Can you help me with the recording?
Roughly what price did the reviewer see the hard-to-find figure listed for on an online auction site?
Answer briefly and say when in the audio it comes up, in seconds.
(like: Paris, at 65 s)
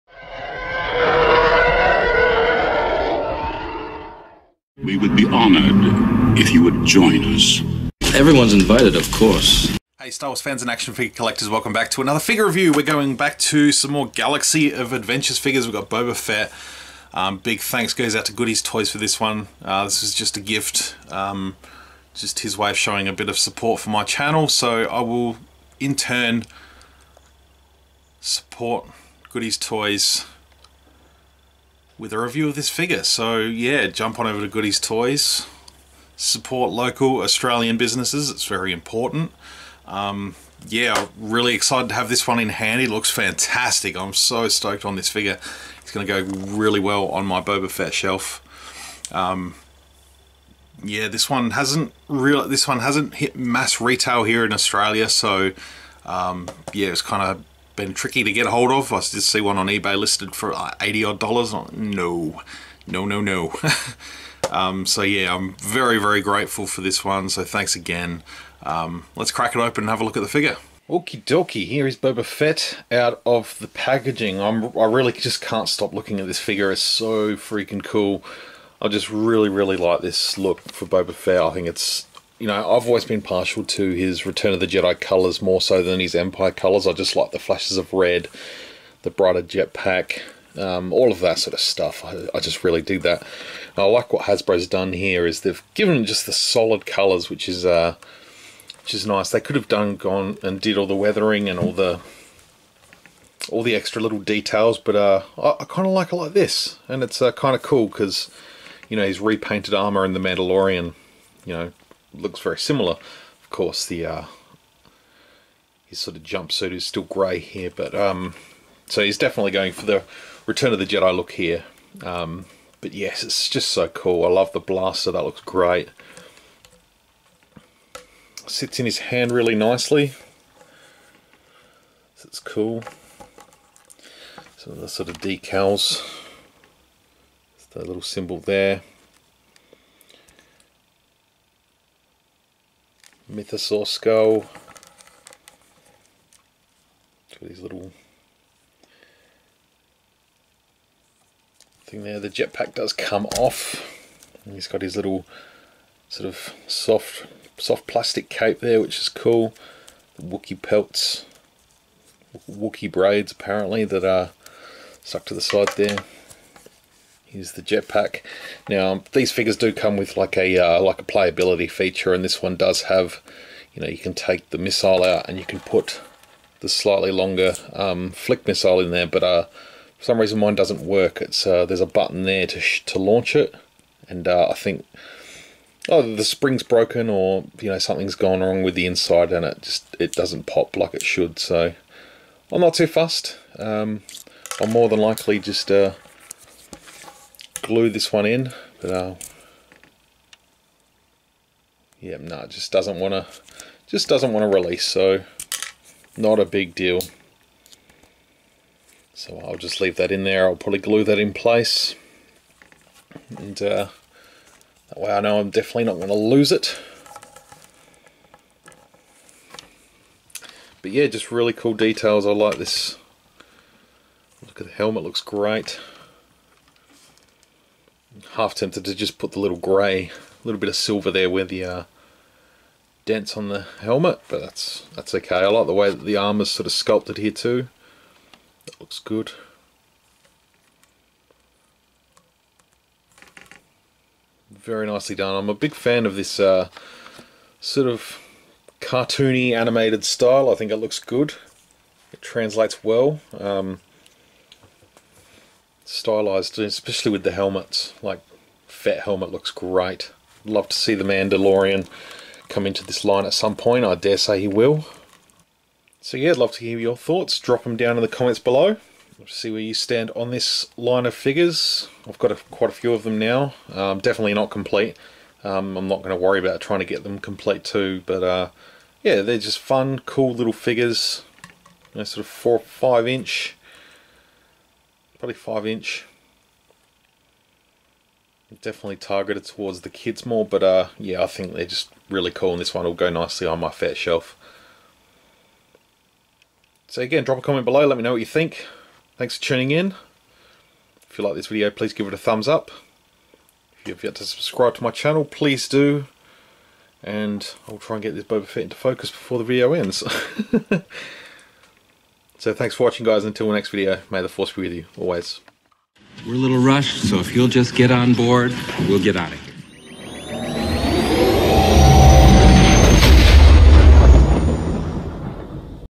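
80 odd dollars, at 60 s.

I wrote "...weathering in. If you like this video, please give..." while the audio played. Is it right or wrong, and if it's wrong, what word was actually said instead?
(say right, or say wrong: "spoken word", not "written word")
wrong: "tuning", not "weathering".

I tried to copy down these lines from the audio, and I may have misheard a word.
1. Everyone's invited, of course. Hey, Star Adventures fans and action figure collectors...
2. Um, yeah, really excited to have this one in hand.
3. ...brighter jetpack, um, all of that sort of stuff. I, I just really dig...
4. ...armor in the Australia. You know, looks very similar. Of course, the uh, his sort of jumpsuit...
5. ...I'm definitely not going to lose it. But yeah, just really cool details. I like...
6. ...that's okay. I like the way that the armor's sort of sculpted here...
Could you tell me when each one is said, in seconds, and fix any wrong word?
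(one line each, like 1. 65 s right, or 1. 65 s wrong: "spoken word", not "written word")
1. 8 s wrong: "Wars", not "Adventures"
2. 39 s right
3. 89 s right
4. 109 s wrong: "Mandalorian", not "Australia"
5. 215 s right
6. 234 s right.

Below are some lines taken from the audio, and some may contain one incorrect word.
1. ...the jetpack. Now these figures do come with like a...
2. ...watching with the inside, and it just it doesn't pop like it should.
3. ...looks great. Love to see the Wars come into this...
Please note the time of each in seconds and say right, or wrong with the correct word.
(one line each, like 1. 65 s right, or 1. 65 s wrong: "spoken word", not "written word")
1. 167 s right
2. 188 s wrong: "wrong", not "watching"
3. 259 s wrong: "Mandalorian", not "Wars".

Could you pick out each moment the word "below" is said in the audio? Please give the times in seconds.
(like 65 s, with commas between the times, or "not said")
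268 s, 297 s.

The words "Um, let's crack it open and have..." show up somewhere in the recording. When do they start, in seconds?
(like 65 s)
68 s.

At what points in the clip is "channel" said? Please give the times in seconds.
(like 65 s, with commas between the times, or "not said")
24 s, 304 s.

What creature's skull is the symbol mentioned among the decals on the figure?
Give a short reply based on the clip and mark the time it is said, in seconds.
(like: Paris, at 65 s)
mythosaur, at 143 s.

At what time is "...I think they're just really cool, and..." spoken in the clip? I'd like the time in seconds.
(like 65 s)
291 s.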